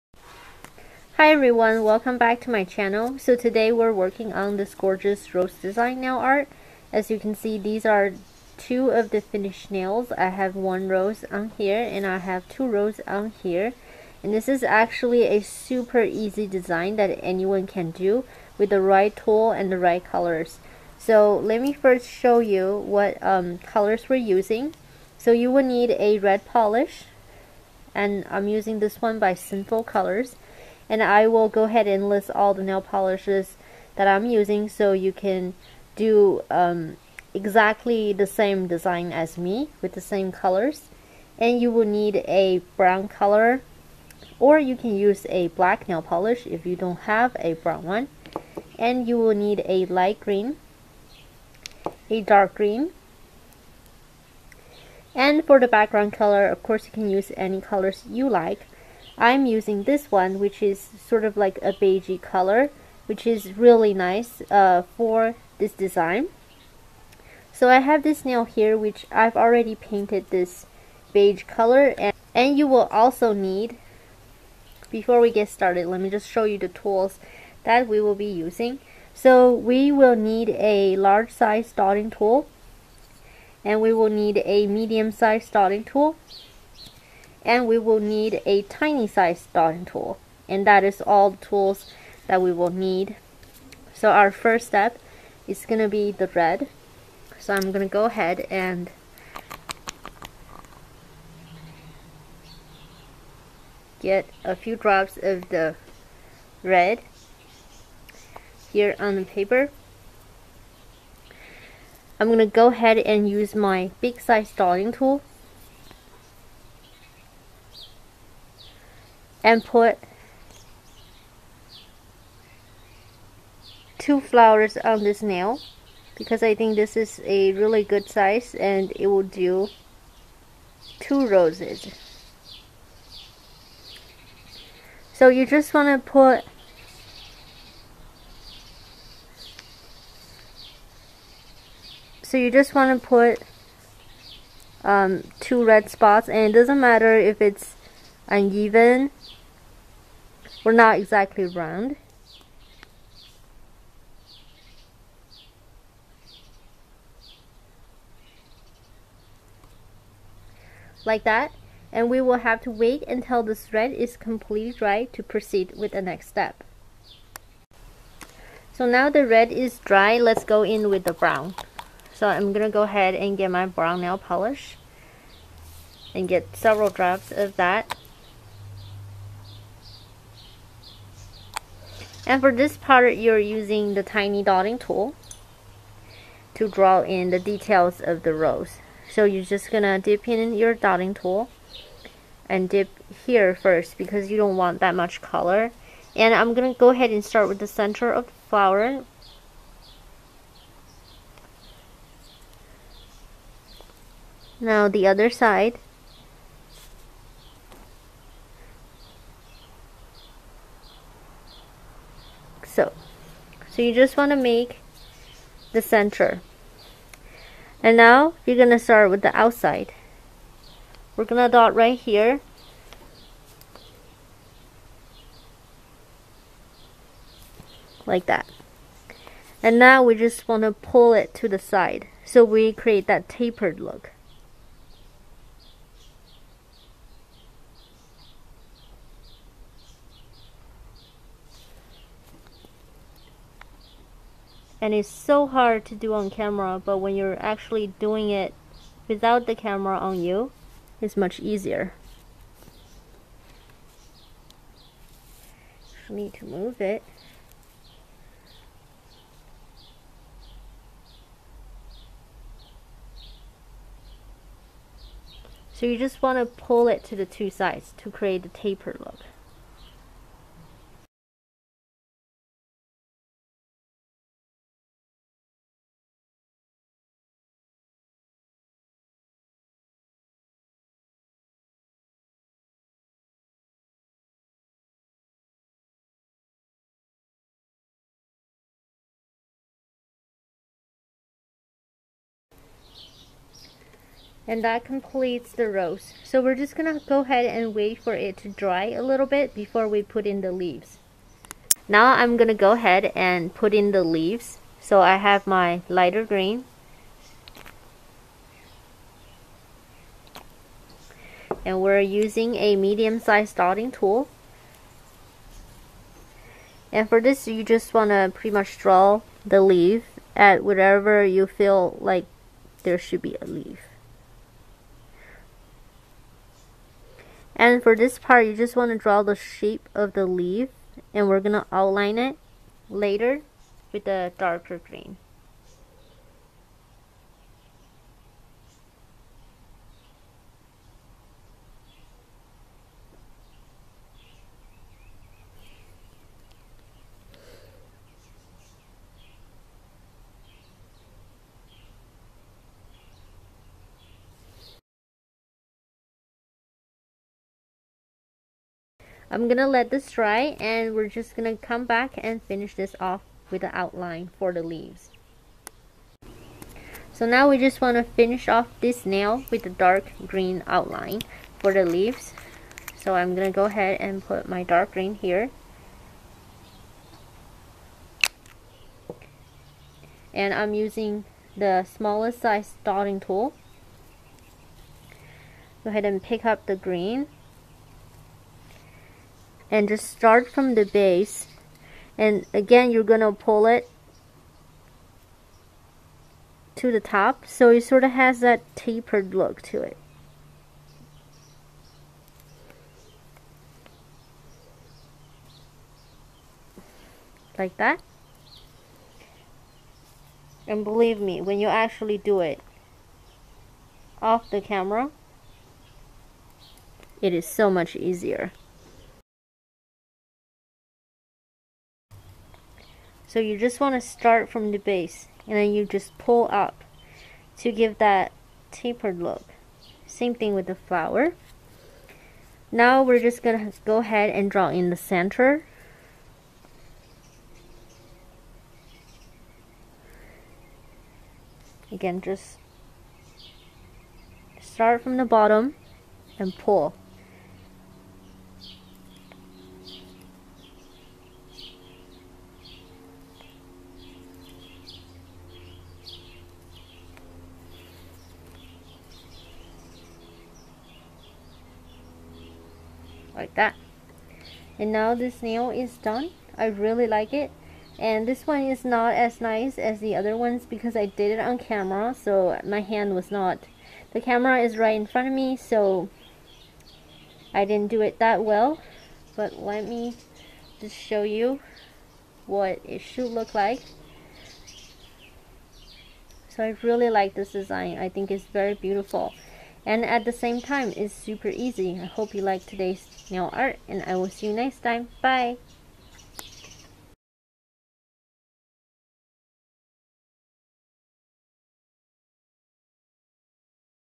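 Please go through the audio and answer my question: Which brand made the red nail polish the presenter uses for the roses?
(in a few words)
Sinful Colors.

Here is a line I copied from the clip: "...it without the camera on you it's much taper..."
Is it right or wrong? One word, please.
wrong.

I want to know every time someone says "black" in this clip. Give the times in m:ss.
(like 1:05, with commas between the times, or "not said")
0:45.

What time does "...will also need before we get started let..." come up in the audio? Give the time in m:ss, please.
1:12.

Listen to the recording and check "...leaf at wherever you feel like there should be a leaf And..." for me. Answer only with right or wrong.
right.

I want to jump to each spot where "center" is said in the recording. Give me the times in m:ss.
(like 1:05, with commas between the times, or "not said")
3:17, 3:35, 7:14.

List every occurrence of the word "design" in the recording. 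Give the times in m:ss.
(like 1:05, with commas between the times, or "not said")
0:05, 0:16, 0:38, 1:05, 8:07.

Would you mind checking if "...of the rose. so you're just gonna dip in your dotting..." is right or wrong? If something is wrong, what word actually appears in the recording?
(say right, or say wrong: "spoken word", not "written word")
right.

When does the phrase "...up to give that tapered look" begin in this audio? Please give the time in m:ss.
7:06.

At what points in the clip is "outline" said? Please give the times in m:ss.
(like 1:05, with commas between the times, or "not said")
5:31, 6:03, 6:10.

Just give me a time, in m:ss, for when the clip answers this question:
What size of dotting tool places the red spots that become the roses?
1:53.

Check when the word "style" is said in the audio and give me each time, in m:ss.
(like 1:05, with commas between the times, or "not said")
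not said.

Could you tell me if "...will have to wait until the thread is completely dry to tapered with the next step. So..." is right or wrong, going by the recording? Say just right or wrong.
wrong.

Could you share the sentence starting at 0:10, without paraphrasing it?
I have one rose on here and I have two roses on here.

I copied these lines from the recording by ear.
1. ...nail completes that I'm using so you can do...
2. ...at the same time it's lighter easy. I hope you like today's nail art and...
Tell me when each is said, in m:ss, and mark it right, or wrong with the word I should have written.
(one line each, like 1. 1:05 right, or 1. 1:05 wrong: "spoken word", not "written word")
1. 0:32 wrong: "polishes", not "completes"
2. 8:10 wrong: "super", not "lighter".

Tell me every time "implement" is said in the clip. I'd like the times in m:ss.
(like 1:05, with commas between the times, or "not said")
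not said.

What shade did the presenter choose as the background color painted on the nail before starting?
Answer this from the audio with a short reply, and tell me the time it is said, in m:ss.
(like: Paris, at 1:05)
beige, at 1:01.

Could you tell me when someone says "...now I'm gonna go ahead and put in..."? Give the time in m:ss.
5:01.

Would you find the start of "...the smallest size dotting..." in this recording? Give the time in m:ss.
6:21.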